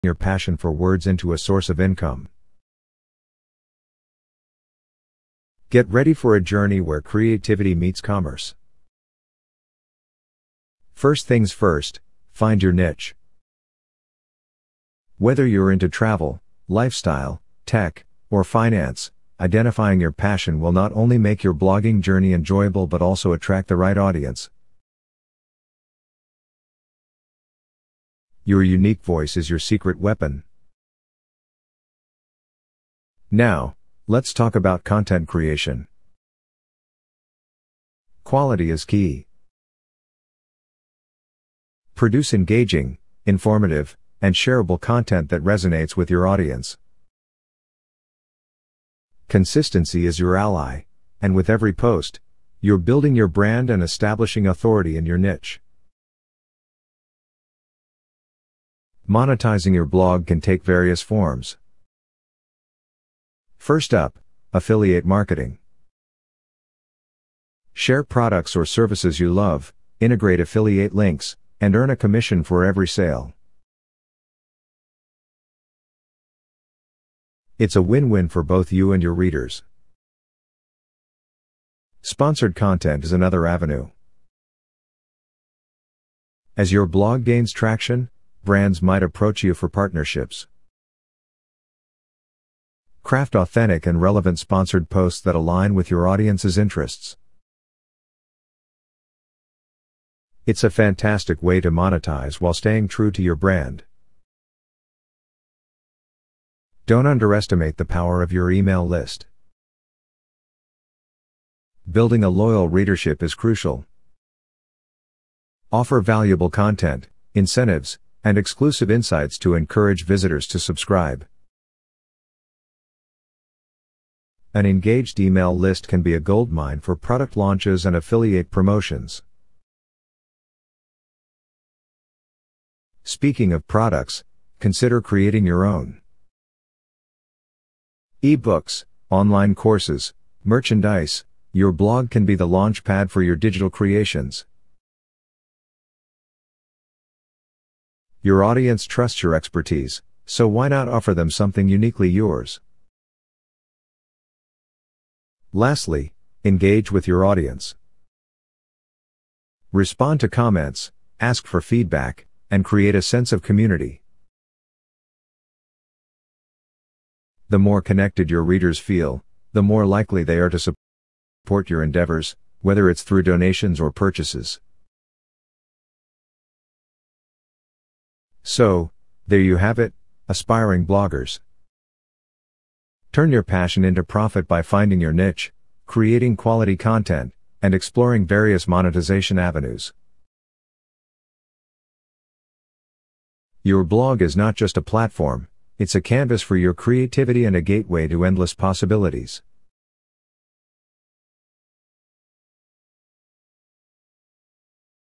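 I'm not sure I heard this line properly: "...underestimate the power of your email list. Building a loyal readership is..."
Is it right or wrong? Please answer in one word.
right.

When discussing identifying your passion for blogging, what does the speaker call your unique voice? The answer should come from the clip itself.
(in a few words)
Your secret weapon.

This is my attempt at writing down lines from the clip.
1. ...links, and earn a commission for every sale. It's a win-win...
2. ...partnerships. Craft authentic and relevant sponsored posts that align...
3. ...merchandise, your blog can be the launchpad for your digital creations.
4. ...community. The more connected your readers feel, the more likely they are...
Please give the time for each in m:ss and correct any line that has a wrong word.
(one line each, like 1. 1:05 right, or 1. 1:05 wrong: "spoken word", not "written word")
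1. 1:10 right
2. 1:29 right
3. 2:20 right
4. 2:43 right.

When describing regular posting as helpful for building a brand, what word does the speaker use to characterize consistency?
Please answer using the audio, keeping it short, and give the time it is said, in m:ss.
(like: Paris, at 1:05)
Your ally, at 0:50.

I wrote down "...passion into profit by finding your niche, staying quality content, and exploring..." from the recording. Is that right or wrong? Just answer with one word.
wrong.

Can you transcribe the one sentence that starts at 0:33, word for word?
Now, let's talk about content creation.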